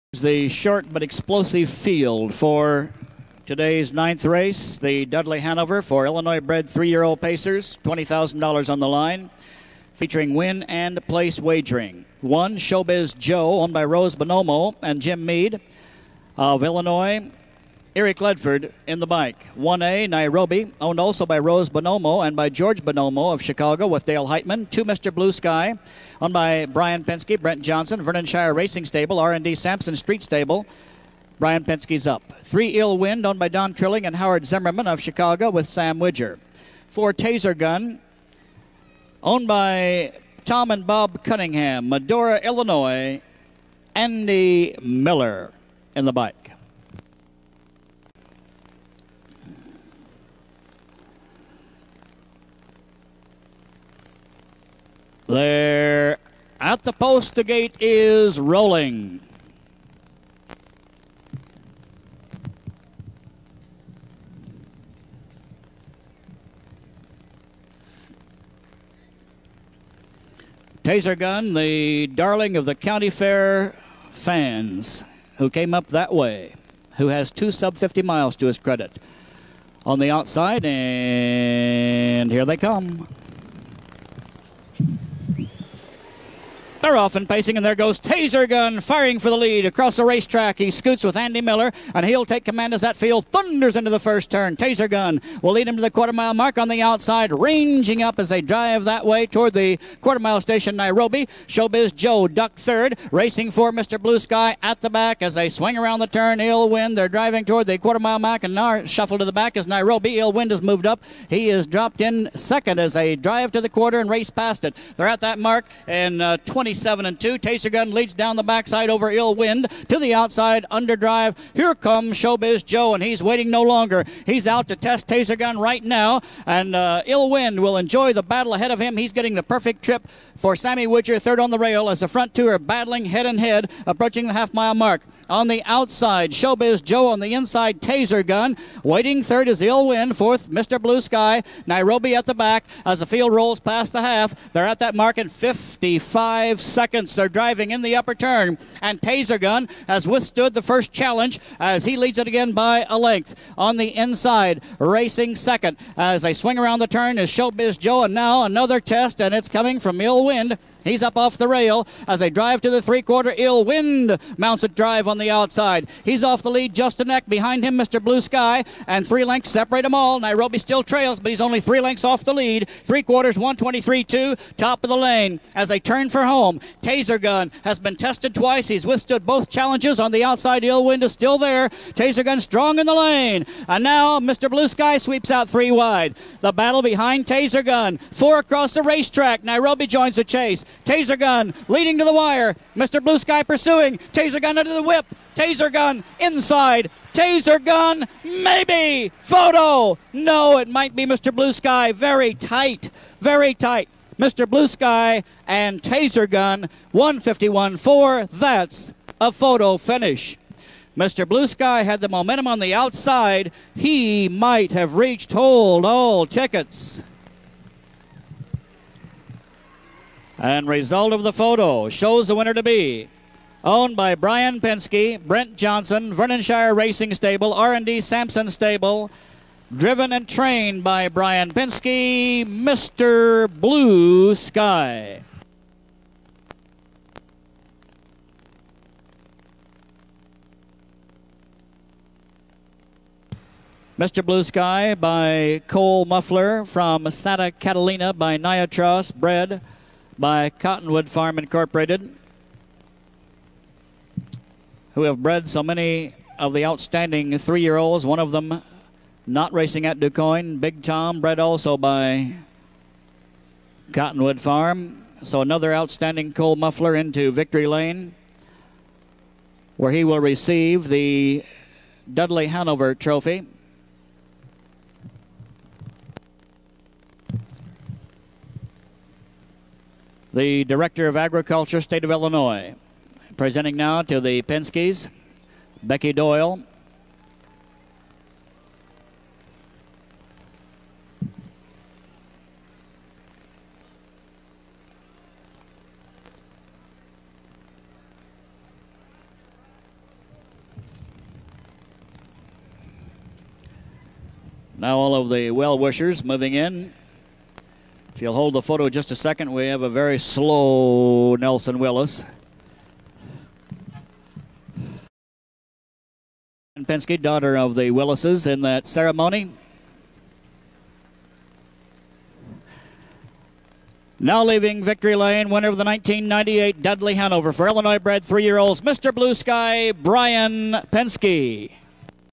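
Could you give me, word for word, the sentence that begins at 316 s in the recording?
And Pinske, daughter of the Willises, in that ceremony.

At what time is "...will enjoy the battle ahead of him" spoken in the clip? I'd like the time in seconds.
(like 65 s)
127 s.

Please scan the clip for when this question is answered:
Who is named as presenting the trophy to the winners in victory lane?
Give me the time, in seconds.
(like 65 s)
285 s.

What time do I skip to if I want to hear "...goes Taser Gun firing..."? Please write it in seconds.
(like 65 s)
87 s.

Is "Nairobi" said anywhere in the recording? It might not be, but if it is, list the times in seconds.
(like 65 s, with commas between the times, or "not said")
20 s, 100 s, 109 s, 141 s, 170 s, 189 s.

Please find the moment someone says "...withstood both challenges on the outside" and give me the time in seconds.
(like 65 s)
178 s.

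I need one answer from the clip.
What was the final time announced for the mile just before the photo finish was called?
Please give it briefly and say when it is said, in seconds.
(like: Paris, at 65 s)
1:51 4, at 206 s.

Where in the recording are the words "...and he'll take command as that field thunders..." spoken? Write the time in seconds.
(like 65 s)
91 s.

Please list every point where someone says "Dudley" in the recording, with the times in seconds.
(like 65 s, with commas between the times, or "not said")
5 s, 272 s, 326 s.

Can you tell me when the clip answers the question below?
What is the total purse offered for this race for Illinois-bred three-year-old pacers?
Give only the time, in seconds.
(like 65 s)
7 s.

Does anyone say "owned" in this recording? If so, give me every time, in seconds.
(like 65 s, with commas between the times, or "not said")
13 s, 20 s, 26 s, 33 s, 39 s, 223 s.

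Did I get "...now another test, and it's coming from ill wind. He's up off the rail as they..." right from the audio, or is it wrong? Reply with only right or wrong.
right.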